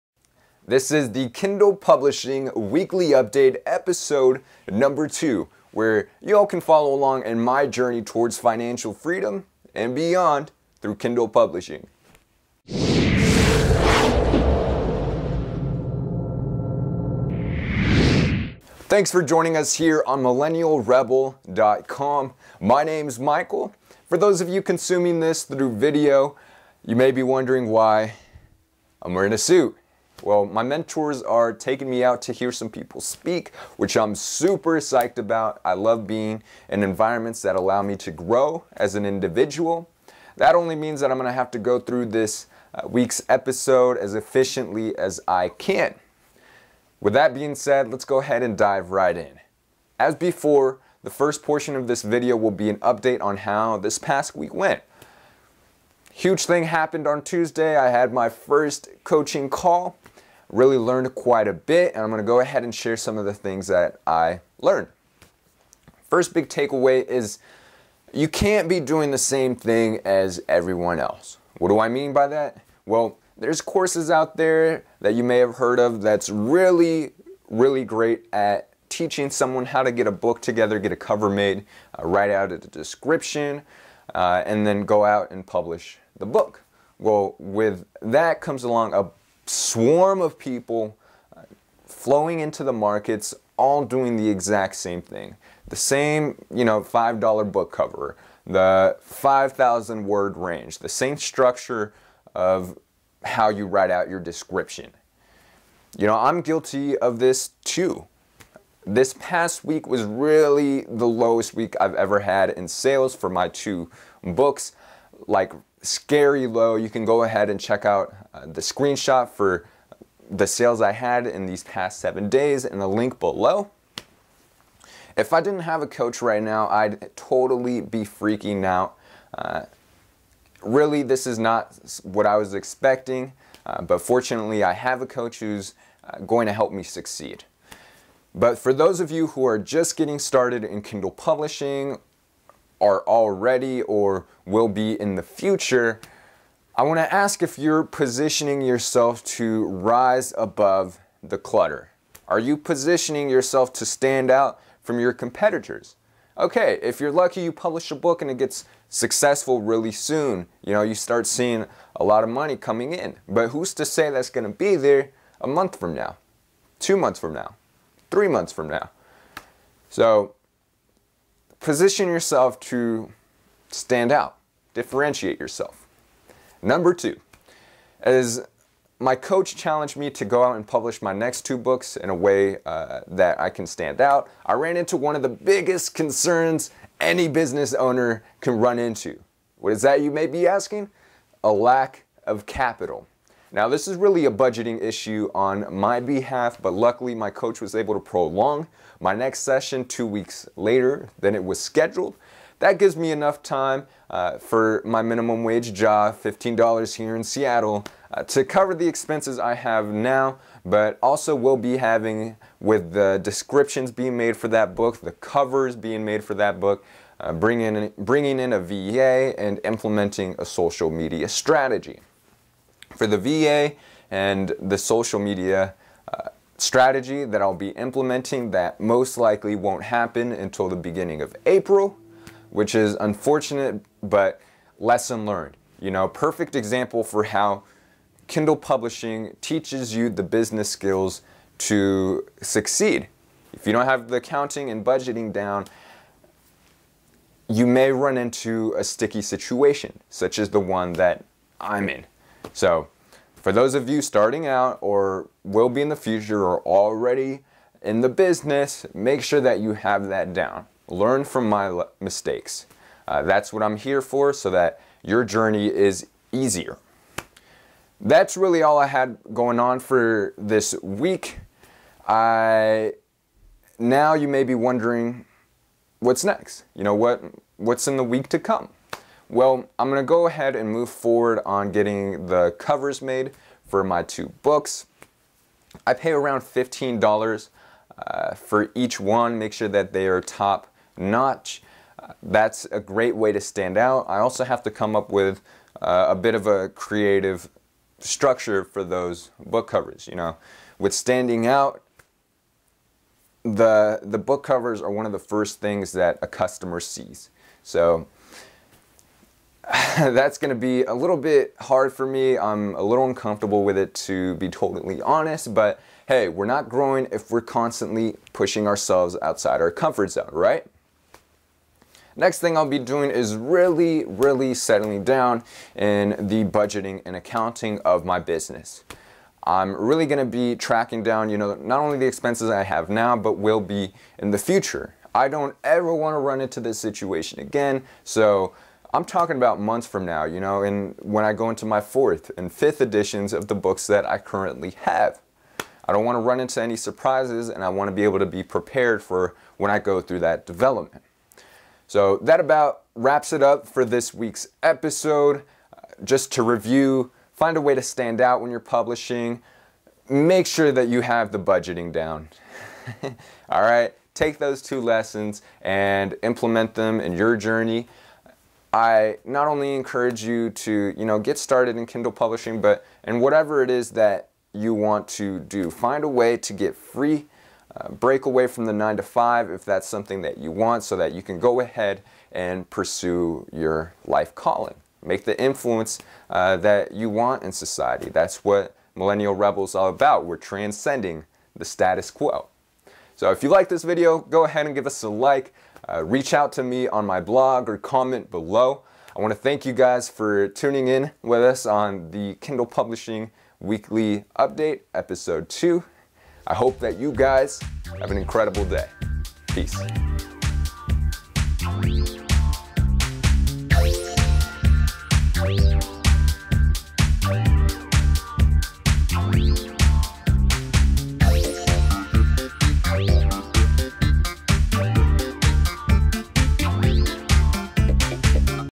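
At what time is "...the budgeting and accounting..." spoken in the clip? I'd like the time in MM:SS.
05:26.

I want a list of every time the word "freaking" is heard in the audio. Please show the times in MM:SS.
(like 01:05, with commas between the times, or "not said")
02:08.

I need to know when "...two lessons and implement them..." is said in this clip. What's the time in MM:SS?
06:04.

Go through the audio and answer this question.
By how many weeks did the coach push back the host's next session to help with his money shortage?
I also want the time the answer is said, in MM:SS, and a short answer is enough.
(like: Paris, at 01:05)
2, at 03:19.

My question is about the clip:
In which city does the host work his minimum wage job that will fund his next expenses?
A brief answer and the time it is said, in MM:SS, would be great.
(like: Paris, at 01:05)
Seattle, at 03:27.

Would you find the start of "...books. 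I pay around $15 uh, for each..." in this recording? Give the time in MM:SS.
04:44.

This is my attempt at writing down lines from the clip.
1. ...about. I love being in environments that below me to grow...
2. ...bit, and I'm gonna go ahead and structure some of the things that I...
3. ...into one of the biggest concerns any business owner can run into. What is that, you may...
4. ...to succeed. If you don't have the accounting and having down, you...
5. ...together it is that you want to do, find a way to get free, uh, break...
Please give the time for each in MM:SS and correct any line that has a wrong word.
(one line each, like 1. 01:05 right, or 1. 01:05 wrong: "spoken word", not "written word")
1. 00:35 wrong: "allow", not "below"
2. 01:01 wrong: "share", not "structure"
3. 03:04 right
4. 04:01 wrong: "budgeting", not "having"
5. 06:13 wrong: "whatever", not "together".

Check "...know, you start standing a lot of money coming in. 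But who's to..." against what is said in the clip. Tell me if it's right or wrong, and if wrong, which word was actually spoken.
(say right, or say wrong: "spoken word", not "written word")
wrong: "seeing", not "standing".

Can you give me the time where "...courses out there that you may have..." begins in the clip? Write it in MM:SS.
01:13.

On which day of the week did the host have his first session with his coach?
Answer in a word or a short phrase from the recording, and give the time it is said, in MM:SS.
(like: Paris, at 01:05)
Tuesday, at 00:57.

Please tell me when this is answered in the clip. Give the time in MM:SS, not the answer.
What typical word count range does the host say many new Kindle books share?
01:39.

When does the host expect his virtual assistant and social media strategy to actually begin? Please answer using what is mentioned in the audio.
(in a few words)
beginning of April.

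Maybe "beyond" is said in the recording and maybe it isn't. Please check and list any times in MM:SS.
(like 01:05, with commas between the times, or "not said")
00:09.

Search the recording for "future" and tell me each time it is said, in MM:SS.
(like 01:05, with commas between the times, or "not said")
02:25, 04:15, 05:34.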